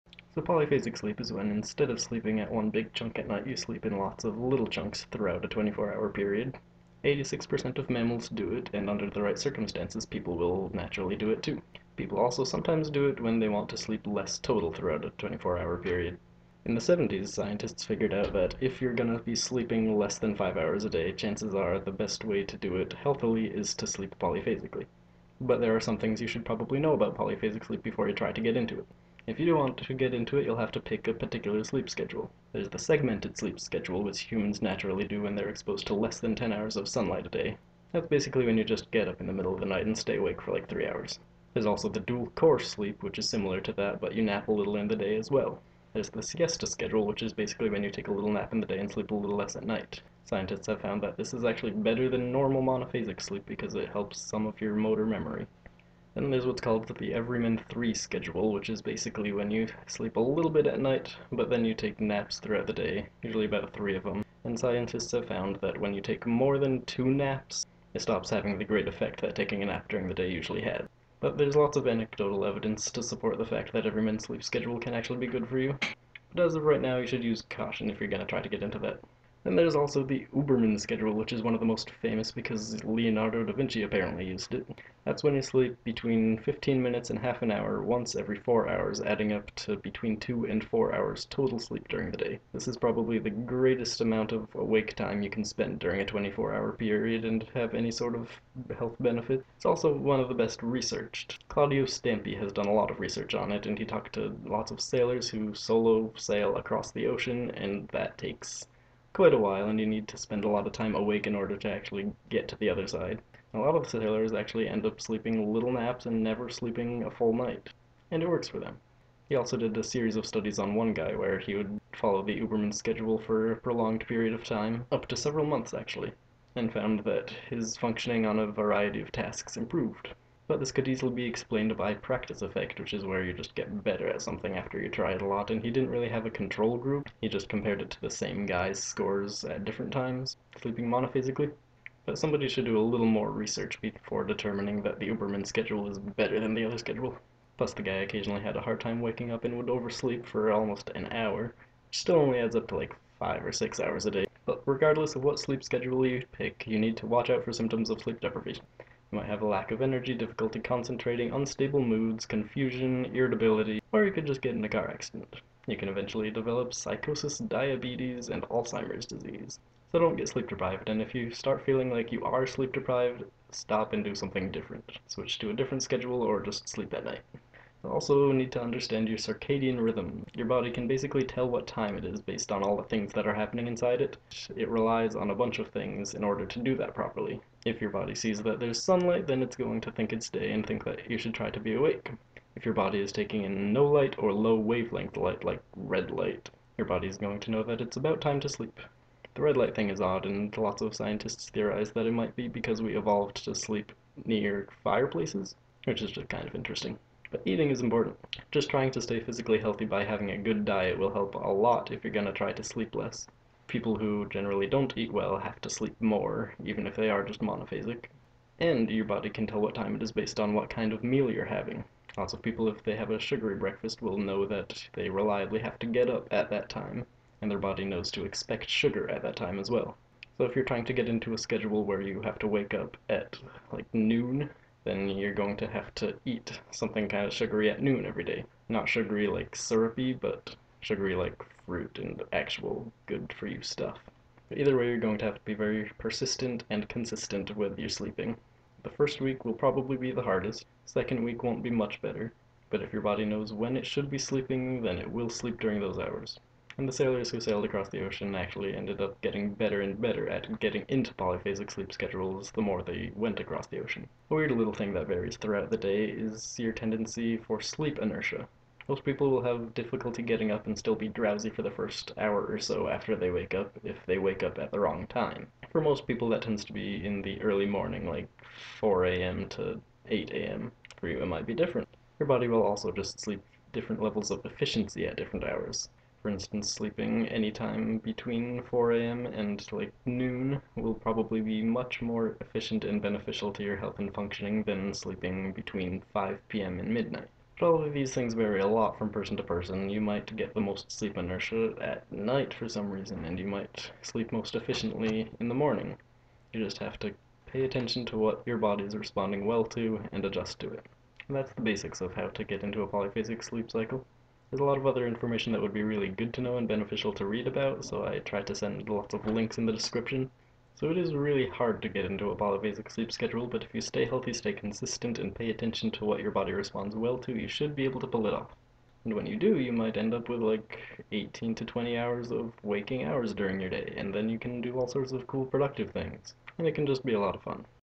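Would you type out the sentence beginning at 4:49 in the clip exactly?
and like noon will probably be much more efficient and beneficial to your health and functioning than sleeping between 5 p.m.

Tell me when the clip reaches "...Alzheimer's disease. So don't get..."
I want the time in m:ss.
2:48.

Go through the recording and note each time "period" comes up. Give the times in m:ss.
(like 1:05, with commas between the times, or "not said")
0:06, 0:15, 1:36, 2:04.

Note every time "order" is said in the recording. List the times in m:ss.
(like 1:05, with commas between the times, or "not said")
1:51, 3:06.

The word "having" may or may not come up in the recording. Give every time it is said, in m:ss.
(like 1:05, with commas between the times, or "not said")
1:08, 3:30, 3:41.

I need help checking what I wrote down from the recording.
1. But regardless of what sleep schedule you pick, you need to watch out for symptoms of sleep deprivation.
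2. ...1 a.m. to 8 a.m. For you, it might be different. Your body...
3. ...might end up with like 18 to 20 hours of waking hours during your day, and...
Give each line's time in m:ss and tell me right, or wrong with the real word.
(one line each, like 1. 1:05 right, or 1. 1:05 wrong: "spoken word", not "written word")
1. 2:34 right
2. 4:38 wrong: "4", not "1"
3. 5:29 right.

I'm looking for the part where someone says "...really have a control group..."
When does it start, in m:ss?
2:15.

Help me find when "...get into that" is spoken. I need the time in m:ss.
1:18.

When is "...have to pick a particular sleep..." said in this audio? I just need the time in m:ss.
0:30.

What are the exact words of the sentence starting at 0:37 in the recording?
That's basically when you just get up in the middle of the night and stay awake for like 3 hours.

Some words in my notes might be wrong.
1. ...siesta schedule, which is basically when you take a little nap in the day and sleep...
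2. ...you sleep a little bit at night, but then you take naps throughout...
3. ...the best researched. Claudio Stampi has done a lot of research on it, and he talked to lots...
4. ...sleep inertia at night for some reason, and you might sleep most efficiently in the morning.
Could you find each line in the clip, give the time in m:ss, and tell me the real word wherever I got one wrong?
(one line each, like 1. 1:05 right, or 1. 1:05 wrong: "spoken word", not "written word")
1. 0:46 right
2. 0:59 right
3. 1:40 right
4. 5:00 right.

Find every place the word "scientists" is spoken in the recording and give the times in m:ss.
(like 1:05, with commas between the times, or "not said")
0:17, 0:50, 1:04, 3:20.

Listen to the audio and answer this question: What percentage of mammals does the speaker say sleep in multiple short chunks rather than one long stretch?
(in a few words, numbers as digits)
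86%.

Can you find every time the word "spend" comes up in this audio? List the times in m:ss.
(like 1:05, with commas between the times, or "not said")
1:35, 1:50.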